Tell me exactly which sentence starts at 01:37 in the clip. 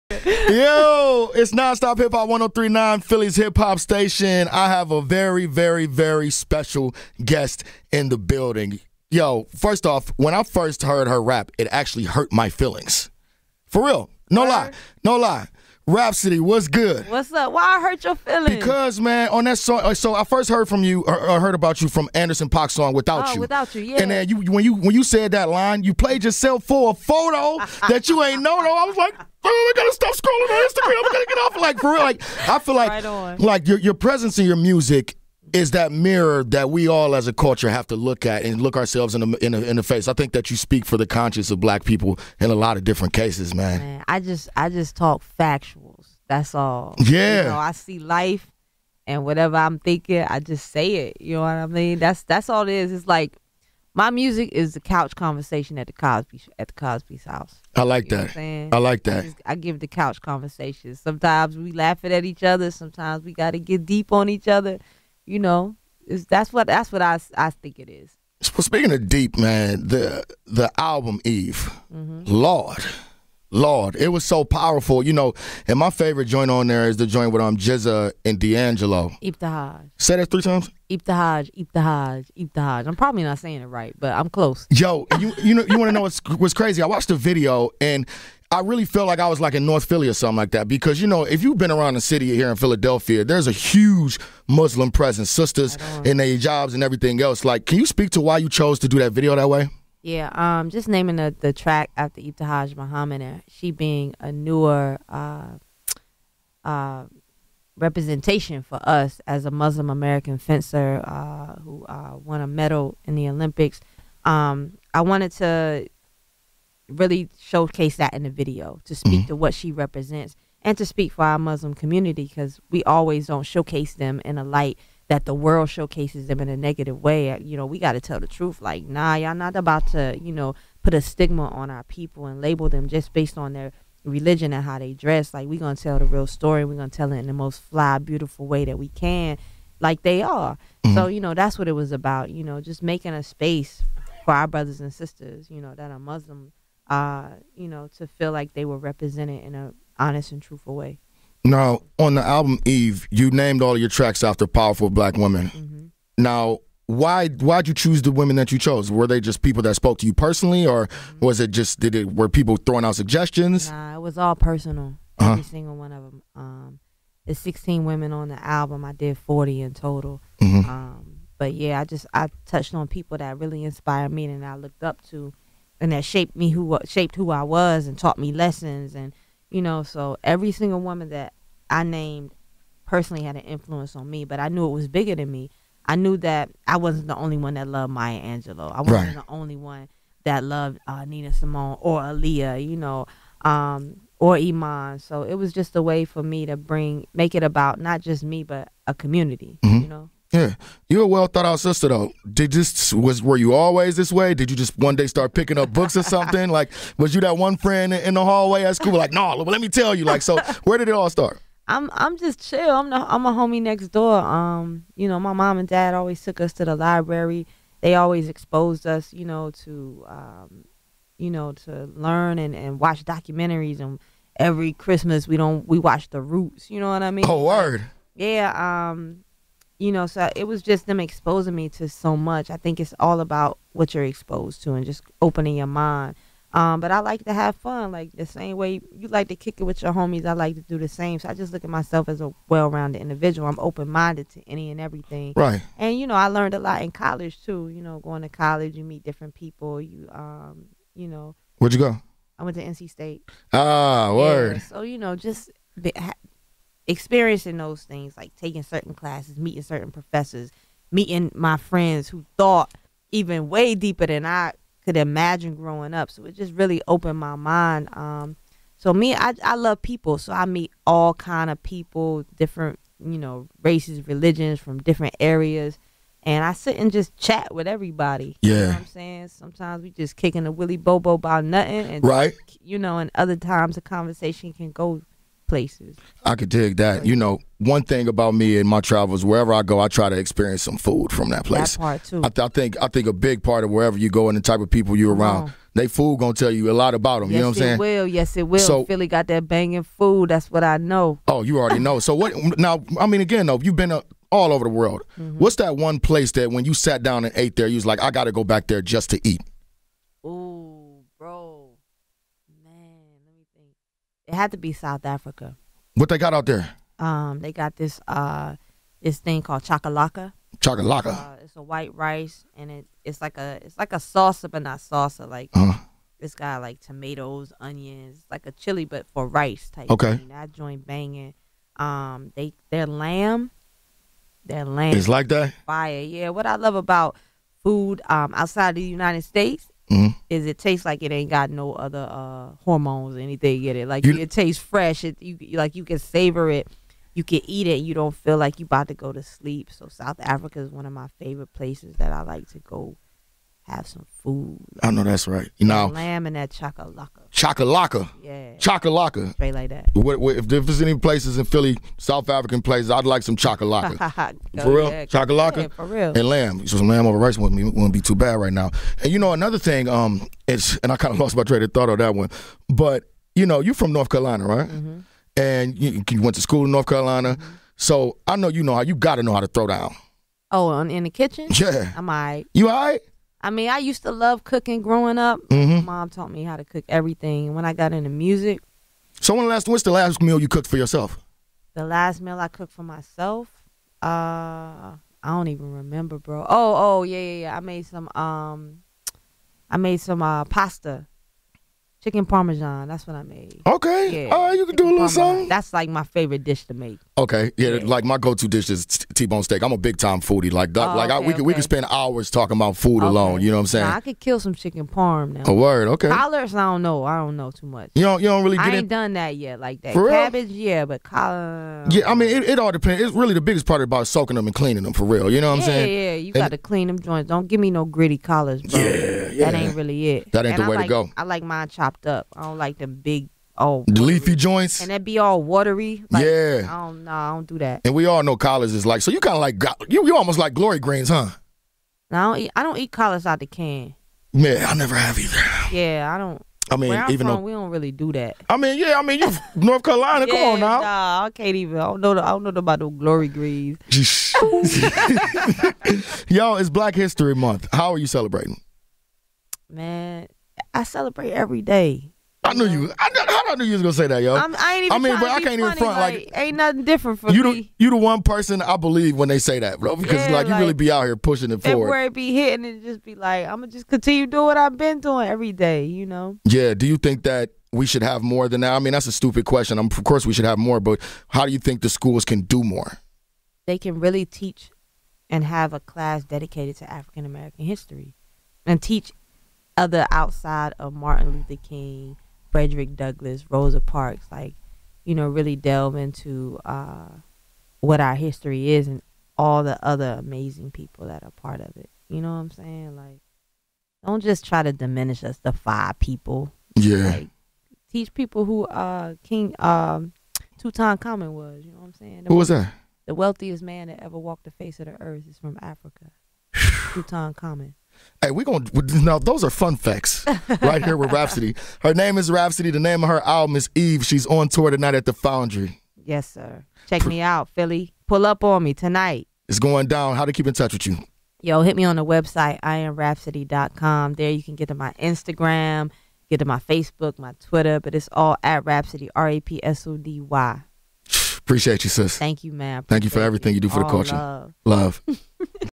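Like, can you speak to why you chose to do that video that way?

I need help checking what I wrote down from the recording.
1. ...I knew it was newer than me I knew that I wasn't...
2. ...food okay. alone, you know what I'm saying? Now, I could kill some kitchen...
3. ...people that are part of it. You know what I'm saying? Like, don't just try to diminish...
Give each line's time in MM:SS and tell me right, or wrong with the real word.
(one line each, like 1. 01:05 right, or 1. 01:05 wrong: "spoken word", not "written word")
1. 03:04 wrong: "bigger", not "newer"
2. 06:52 wrong: "chicken", not "kitchen"
3. 08:20 right.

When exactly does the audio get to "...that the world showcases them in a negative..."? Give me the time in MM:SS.
02:05.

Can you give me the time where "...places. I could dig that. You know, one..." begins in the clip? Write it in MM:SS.
04:45.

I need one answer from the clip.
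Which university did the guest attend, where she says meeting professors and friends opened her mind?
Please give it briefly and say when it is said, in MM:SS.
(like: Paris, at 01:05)
NC State, at 04:12.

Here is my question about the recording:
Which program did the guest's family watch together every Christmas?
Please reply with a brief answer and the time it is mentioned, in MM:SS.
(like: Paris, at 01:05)
The Roots, at 03:46.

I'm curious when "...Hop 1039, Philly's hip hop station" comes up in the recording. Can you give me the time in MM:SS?
00:02.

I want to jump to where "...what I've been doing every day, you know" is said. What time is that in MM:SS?
07:54.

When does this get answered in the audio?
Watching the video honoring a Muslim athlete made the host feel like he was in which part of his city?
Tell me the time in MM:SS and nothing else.
01:29.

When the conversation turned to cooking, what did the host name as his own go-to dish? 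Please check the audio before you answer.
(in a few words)
T-bone steak.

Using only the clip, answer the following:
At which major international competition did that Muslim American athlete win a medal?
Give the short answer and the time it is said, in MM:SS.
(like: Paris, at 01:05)
The Olympics, at 01:53.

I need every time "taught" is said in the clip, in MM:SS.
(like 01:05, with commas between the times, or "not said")
02:57, 06:26.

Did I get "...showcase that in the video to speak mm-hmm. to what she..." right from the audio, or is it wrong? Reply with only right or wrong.
right.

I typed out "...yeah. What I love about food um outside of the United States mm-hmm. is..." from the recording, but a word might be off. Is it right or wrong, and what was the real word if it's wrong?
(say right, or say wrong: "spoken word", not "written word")
right.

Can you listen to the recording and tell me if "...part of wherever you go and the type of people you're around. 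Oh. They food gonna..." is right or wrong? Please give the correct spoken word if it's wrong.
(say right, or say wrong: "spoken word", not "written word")
right.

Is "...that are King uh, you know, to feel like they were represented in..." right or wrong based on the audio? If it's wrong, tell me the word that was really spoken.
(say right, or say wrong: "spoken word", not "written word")
wrong: "Muslim", not "King".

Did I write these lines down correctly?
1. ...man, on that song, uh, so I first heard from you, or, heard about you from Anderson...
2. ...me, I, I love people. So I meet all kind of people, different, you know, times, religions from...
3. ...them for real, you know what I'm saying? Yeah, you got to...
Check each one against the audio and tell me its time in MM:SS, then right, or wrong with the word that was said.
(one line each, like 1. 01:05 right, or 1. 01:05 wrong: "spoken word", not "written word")
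1. 00:18 right
2. 04:28 wrong: "races", not "times"
3. 07:04 right.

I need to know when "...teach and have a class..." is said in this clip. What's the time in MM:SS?
08:04.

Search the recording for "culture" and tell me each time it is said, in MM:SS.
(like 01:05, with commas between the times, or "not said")
00:37, 09:03.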